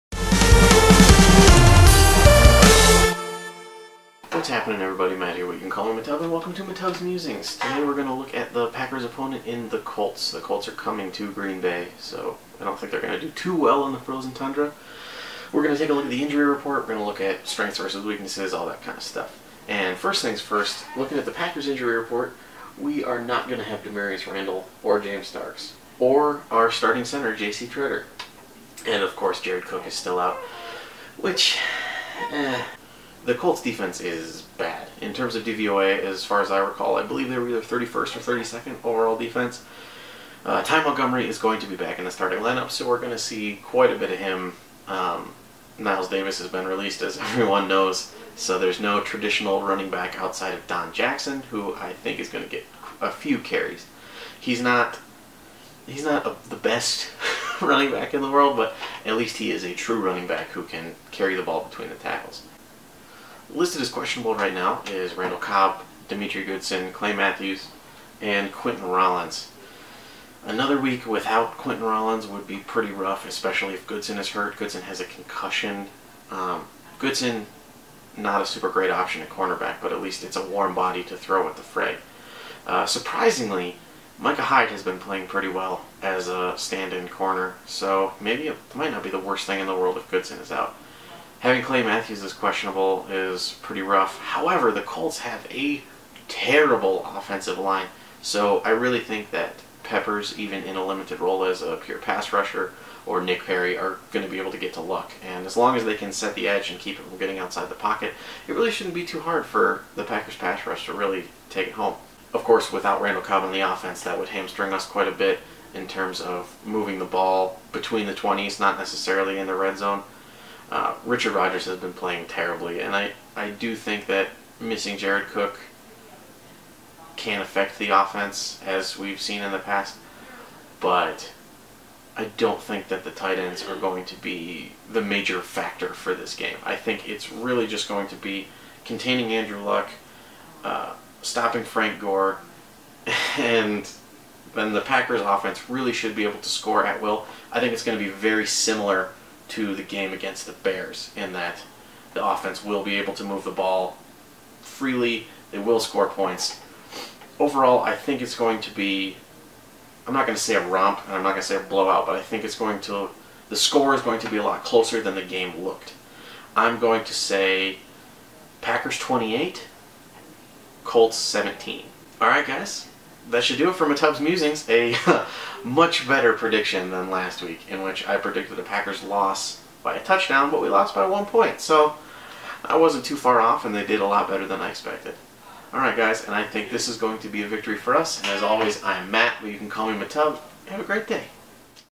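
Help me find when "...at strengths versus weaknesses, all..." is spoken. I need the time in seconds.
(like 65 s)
17 s.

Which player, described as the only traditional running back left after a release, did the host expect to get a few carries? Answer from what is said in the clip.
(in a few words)
Don Jackson.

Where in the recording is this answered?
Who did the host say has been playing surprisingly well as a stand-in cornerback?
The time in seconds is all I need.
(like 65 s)
84 s.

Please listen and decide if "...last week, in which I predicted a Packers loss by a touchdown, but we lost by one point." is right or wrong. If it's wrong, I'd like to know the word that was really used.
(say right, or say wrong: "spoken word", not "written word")
right.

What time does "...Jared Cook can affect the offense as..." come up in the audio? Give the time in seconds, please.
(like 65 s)
124 s.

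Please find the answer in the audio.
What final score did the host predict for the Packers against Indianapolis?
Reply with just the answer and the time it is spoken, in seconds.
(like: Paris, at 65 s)
Packers 28, Colts 17, at 168 s.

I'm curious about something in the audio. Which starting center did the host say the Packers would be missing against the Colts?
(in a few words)
J.C. Tretter.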